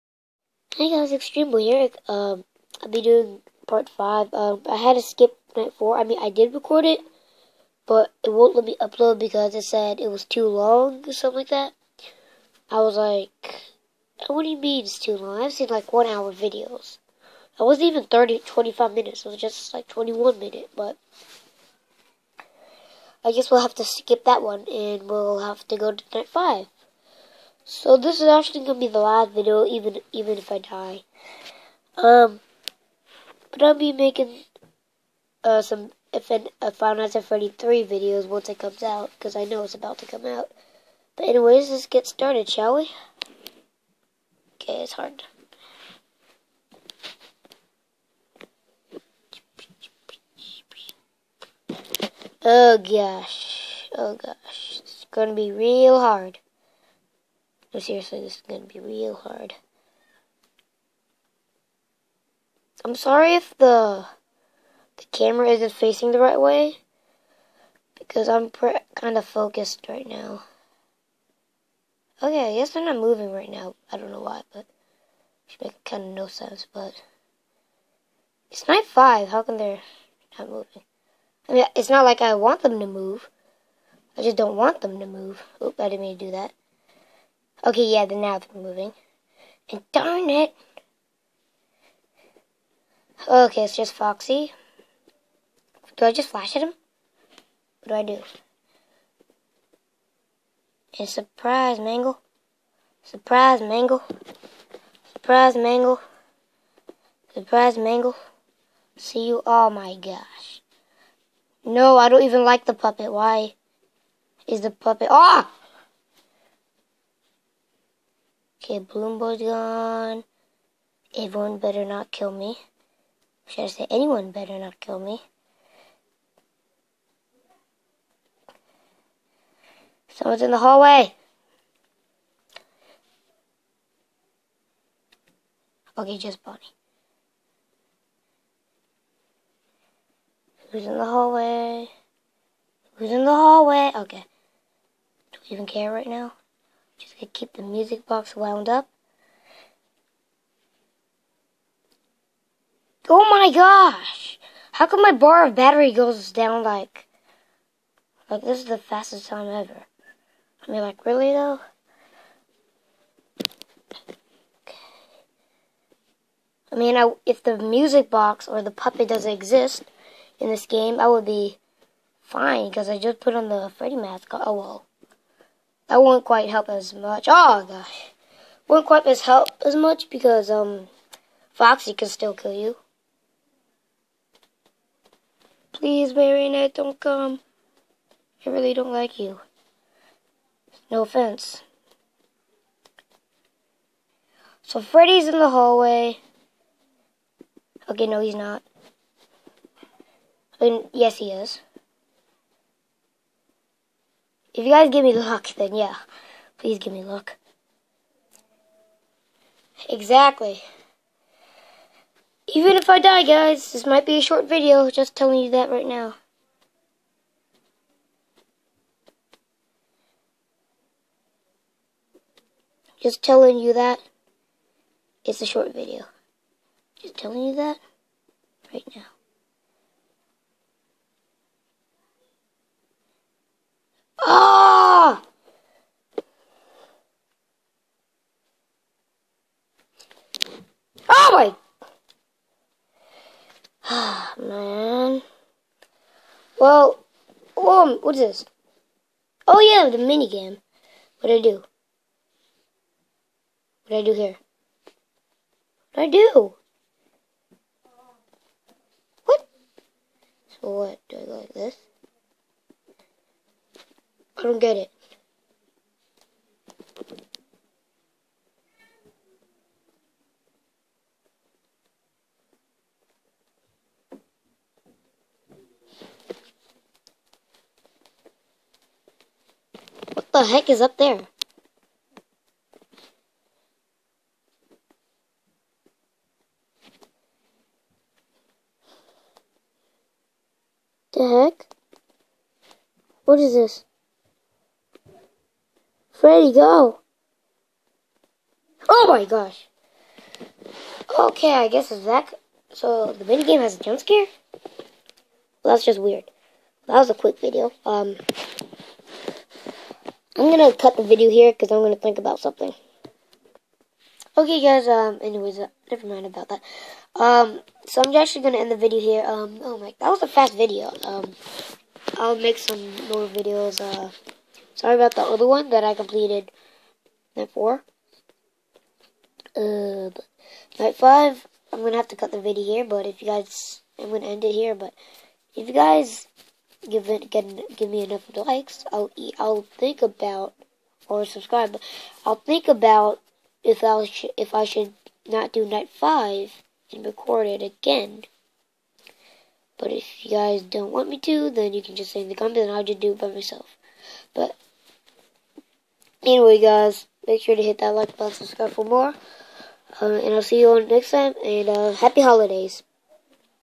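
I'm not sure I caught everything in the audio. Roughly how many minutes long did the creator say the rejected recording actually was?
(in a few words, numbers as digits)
21.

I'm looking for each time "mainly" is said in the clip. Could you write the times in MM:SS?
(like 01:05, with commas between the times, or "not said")
not said.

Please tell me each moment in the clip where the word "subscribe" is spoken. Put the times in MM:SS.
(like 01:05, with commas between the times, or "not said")
05:41, 05:58.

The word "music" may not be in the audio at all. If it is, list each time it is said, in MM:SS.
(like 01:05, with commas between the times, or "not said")
02:27, 02:47.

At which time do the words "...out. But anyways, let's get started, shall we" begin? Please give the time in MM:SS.
00:40.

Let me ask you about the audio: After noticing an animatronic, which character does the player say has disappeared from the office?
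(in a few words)
Balloon Boy.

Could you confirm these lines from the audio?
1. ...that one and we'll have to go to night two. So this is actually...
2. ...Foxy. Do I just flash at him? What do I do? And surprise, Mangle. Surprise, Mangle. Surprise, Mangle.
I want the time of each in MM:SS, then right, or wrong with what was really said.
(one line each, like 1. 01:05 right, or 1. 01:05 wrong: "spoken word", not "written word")
1. 00:24 wrong: "five", not "two"
2. 01:33 right.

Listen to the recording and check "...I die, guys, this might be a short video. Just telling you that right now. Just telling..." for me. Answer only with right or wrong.
right.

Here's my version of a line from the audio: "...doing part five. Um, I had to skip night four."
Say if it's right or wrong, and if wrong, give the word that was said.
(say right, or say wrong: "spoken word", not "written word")
right.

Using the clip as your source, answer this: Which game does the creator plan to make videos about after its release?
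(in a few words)
Final Fantasy 33.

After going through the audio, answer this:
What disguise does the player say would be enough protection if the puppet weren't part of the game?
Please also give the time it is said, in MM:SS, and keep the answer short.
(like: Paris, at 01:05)
Freddy mask, at 02:53.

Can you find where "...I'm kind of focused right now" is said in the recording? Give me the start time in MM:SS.
01:08.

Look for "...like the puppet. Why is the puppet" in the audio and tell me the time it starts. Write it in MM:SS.
01:52.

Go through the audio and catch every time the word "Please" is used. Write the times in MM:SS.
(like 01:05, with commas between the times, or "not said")
03:05, 03:26.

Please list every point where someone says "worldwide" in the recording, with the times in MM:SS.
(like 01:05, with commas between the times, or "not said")
not said.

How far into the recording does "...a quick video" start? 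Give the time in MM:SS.
05:07.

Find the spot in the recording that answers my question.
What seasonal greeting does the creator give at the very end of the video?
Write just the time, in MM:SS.
06:01.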